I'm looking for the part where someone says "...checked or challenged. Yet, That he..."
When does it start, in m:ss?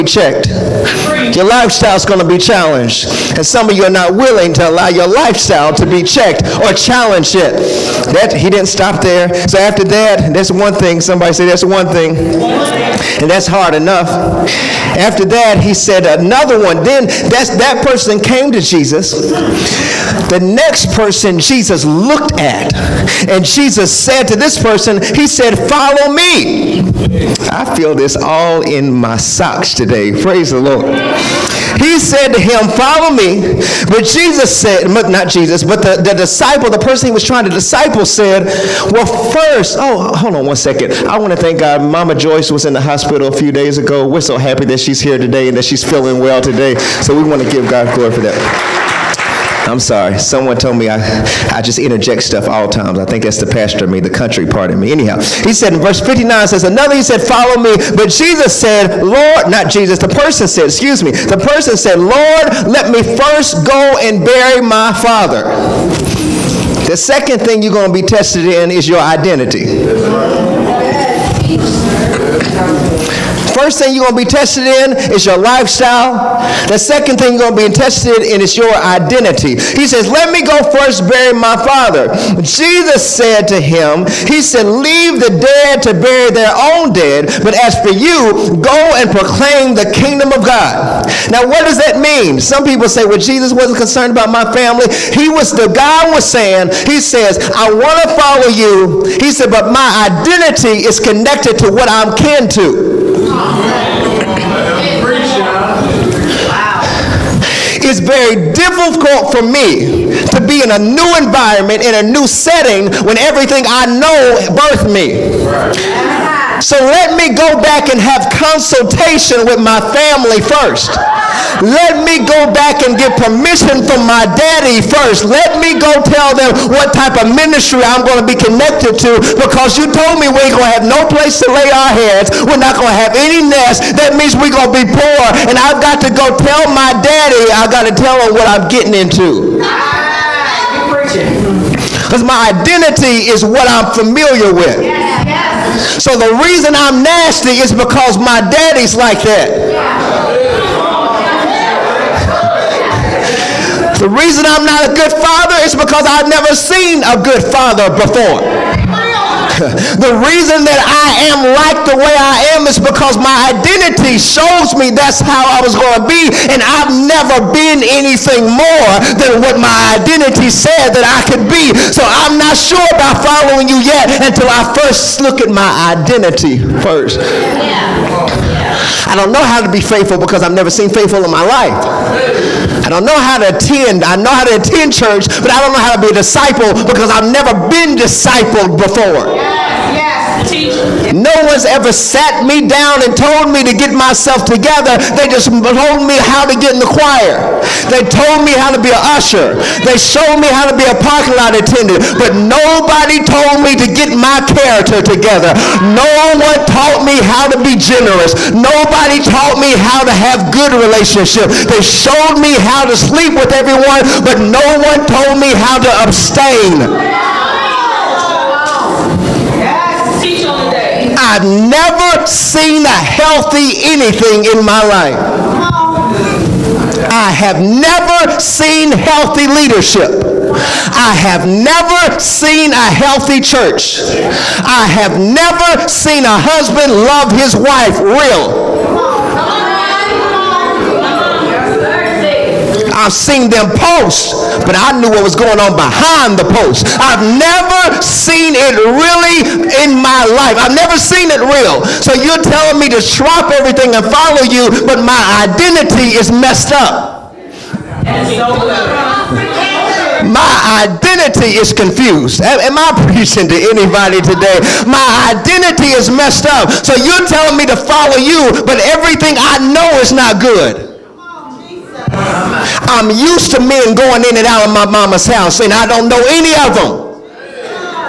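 0:06.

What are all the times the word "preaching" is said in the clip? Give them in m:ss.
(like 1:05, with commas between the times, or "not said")
4:23.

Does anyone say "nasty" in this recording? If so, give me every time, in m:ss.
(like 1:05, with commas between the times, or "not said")
2:27.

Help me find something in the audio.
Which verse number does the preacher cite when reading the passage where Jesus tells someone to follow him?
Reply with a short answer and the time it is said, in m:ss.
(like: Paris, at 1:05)
59, at 0:55.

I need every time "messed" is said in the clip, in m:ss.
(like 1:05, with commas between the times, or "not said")
4:16, 4:26.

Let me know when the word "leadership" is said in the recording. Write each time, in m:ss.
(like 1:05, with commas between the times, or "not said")
3:49.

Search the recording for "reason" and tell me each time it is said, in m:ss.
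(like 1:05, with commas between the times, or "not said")
2:26, 2:34, 2:40.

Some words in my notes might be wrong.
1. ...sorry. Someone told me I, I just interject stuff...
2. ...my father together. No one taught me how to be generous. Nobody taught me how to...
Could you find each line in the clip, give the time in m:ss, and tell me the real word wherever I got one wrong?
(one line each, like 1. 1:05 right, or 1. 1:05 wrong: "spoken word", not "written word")
1. 0:49 right
2. 3:24 wrong: "character", not "father".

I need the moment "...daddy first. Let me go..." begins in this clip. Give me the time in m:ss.
2:04.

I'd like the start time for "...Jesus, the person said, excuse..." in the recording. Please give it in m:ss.
0:59.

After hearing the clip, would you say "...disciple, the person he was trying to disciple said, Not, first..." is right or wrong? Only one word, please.
wrong.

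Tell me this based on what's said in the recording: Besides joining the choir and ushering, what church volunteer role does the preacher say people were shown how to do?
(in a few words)
Parking lot attendant.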